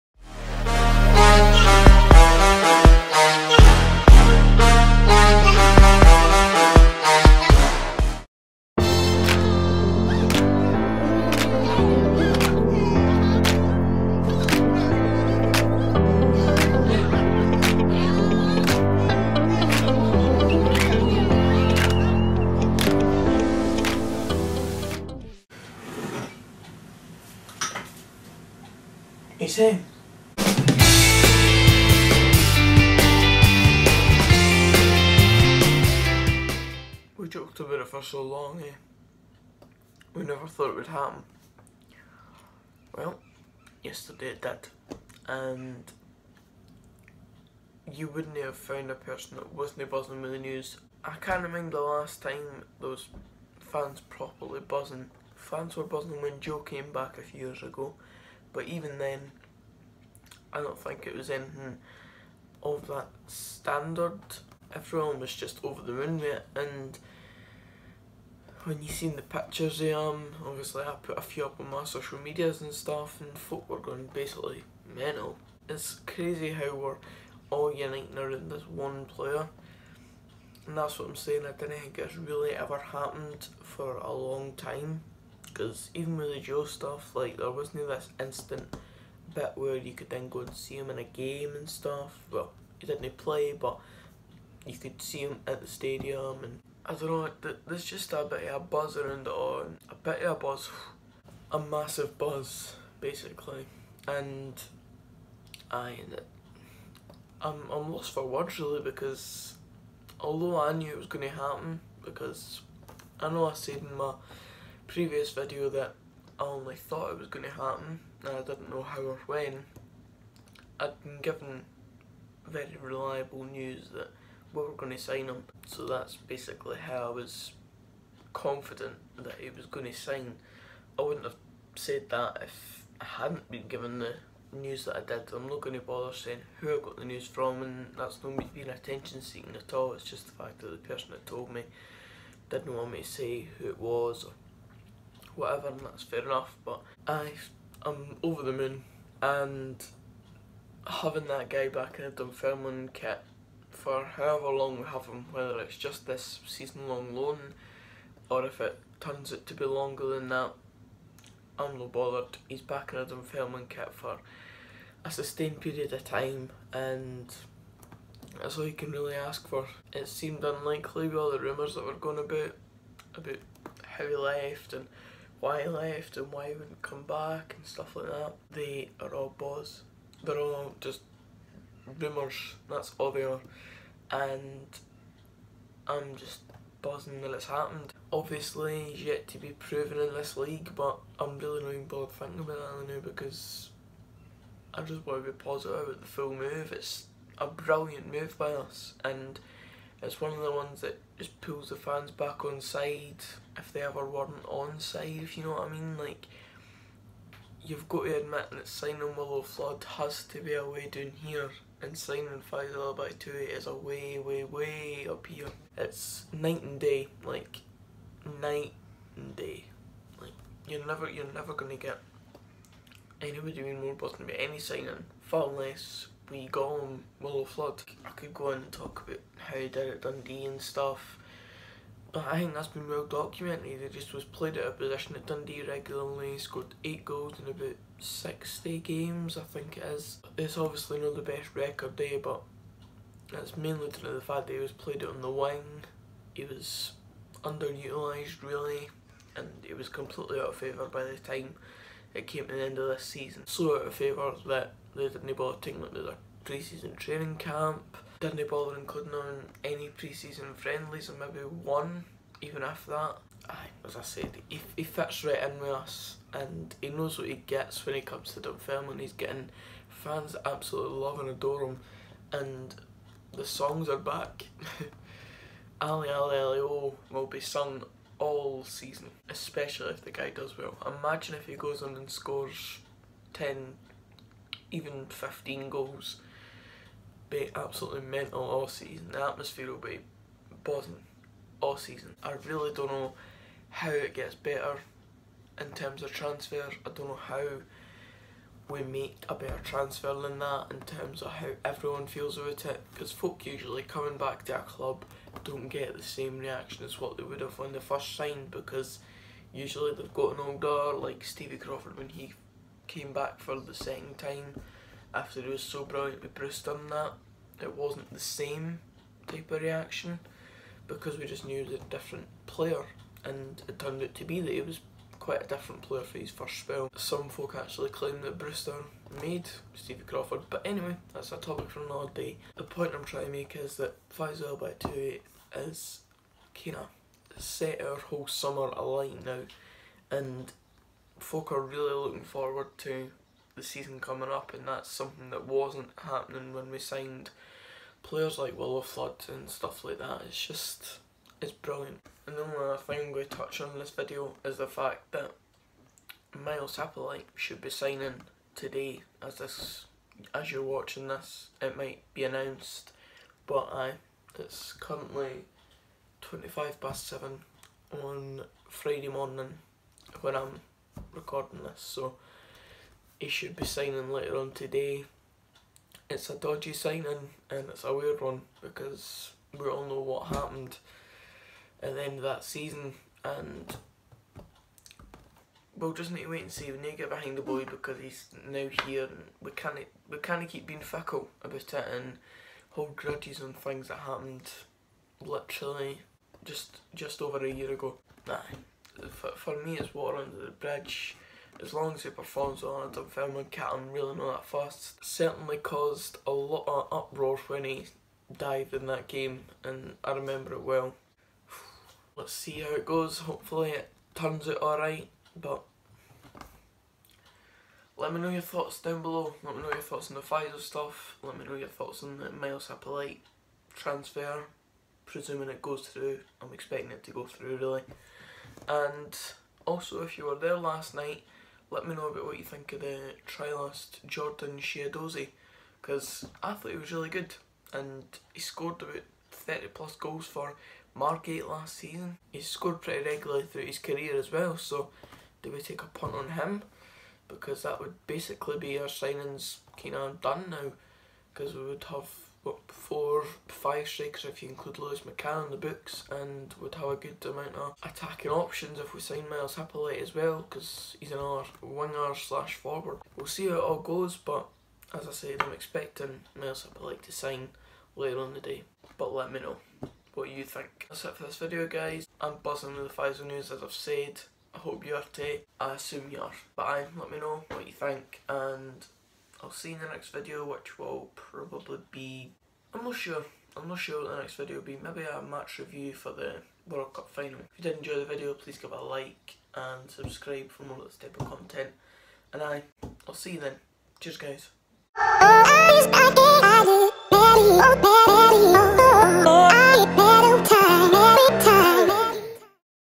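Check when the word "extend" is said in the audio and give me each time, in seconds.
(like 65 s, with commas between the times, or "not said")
not said.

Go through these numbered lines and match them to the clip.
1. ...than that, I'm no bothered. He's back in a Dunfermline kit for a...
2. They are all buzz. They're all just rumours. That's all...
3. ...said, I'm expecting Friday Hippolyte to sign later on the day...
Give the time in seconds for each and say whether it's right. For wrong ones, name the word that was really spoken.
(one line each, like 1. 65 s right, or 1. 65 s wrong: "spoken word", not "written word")
1. 160 s right
2. 178 s right
3. 465 s wrong: "Myles", not "Friday".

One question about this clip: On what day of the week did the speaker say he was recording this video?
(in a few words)
Friday.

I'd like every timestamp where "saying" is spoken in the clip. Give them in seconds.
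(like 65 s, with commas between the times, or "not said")
81 s, 136 s.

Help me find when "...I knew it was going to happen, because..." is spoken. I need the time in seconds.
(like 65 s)
110 s.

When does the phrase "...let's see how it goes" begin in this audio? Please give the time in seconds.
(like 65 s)
412 s.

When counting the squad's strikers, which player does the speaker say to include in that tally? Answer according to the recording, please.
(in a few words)
Lewis McCann.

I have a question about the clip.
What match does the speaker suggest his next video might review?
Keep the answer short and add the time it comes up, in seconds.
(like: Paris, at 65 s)
World Cup final, at 486 s.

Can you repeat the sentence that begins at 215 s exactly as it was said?
It's night and day, like, night and day.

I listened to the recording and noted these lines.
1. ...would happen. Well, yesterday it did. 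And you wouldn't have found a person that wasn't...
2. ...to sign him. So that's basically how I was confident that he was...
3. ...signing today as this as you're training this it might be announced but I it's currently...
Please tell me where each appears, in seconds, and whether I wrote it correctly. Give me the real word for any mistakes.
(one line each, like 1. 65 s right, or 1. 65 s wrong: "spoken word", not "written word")
1. 40 s right
2. 124 s right
3. 357 s wrong: "watching", not "training".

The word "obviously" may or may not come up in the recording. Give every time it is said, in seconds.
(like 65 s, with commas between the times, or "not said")
70 s, 188 s, 240 s.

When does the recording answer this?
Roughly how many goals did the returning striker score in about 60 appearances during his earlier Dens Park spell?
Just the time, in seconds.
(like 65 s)
236 s.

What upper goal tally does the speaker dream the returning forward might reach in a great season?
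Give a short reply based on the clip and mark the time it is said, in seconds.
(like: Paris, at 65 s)
15, at 285 s.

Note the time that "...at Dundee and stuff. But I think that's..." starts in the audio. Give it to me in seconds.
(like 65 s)
229 s.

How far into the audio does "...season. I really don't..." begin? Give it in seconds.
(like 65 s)
291 s.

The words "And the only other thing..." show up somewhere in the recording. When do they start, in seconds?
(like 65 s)
352 s.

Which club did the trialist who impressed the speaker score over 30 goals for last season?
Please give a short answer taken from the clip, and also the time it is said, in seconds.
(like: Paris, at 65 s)
Margate, at 440 s.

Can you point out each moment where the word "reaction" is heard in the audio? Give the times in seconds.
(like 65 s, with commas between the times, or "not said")
306 s, 319 s.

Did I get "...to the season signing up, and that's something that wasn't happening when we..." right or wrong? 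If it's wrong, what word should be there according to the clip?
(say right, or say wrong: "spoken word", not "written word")
wrong: "coming", not "signing".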